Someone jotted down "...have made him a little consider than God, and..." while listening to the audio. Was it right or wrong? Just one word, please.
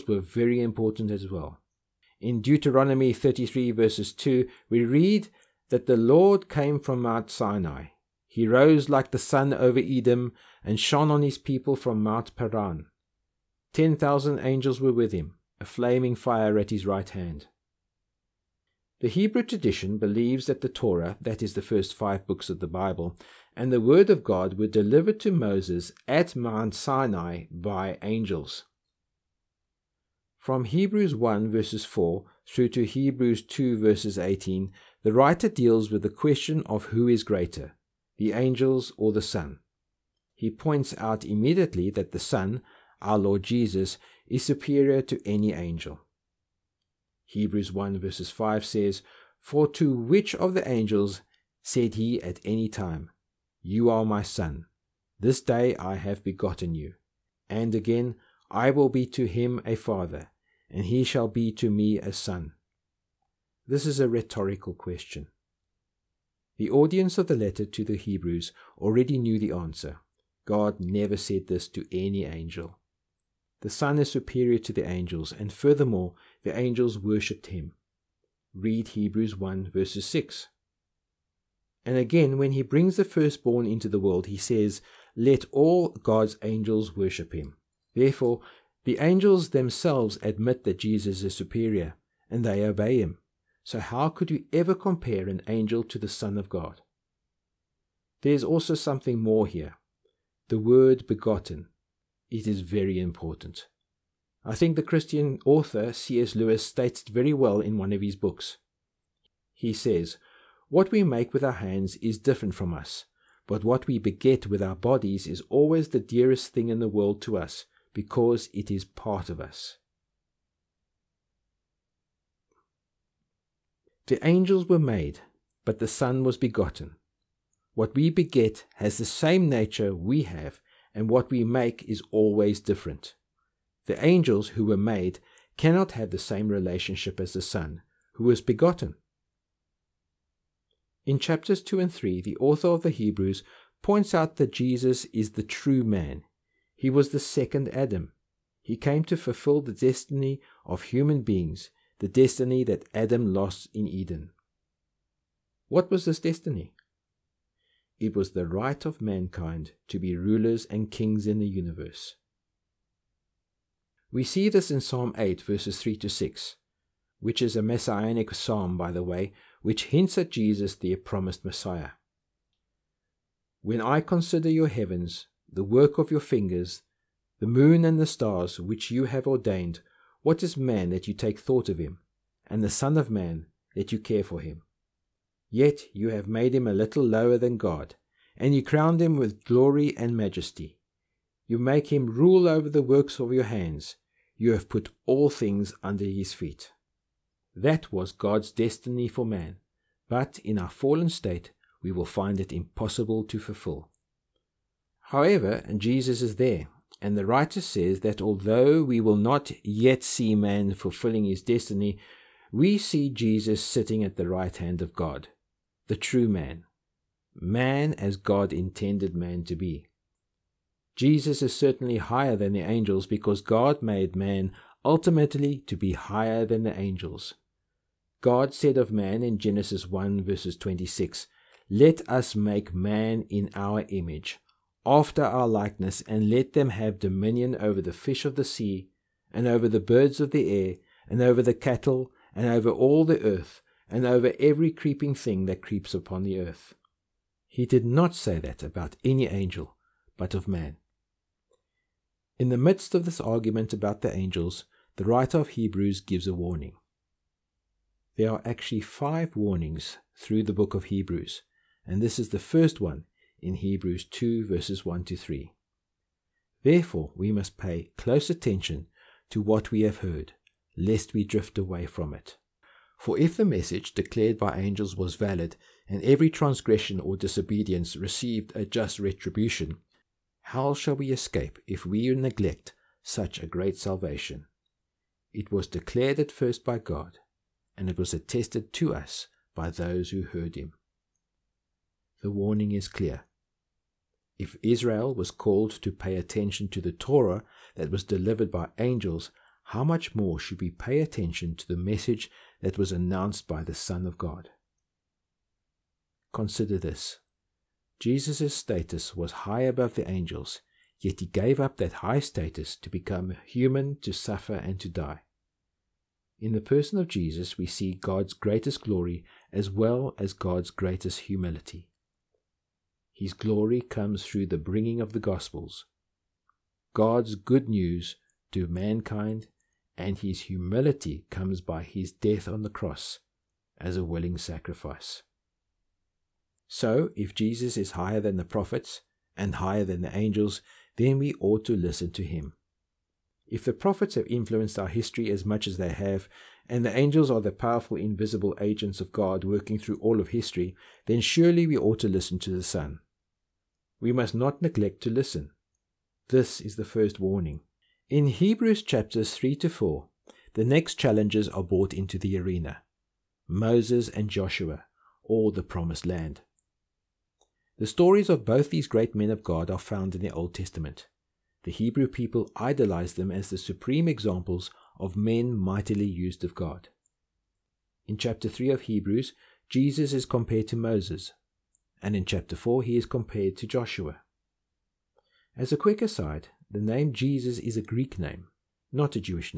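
wrong.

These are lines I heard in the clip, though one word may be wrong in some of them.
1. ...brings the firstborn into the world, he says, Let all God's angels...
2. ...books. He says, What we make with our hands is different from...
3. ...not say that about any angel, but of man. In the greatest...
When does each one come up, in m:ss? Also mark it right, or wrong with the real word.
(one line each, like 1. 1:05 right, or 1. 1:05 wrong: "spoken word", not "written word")
1. 1:22 right
2. 1:48 right
3. 4:07 wrong: "midst", not "greatest".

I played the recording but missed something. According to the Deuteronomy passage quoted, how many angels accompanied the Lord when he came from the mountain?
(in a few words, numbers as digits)
10,000.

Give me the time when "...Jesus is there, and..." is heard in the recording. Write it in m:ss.
3:25.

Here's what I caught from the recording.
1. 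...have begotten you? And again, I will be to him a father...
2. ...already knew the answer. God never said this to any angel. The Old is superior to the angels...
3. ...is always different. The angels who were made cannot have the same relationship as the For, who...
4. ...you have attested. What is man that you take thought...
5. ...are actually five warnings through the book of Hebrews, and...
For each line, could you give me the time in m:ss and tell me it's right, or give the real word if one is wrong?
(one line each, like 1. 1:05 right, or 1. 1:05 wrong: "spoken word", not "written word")
1. 0:55 right
2. 1:08 wrong: "Son", not "Old"
3. 2:11 wrong: "Son", not "For"
4. 2:58 wrong: "ordained", not "attested"
5. 4:18 right.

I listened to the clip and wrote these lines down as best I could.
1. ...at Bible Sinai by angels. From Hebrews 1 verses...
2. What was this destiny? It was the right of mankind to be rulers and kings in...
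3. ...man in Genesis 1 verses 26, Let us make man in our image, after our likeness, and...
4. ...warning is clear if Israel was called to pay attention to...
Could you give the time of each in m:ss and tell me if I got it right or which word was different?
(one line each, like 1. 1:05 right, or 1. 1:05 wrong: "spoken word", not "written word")
1. 0:26 wrong: "Mount", not "Bible"
2. 2:35 right
3. 3:48 right
4. 4:52 right.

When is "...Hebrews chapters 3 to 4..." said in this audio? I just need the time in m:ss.
5:58.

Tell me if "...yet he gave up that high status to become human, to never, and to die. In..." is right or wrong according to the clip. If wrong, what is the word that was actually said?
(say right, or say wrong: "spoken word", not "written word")
wrong: "suffer", not "never".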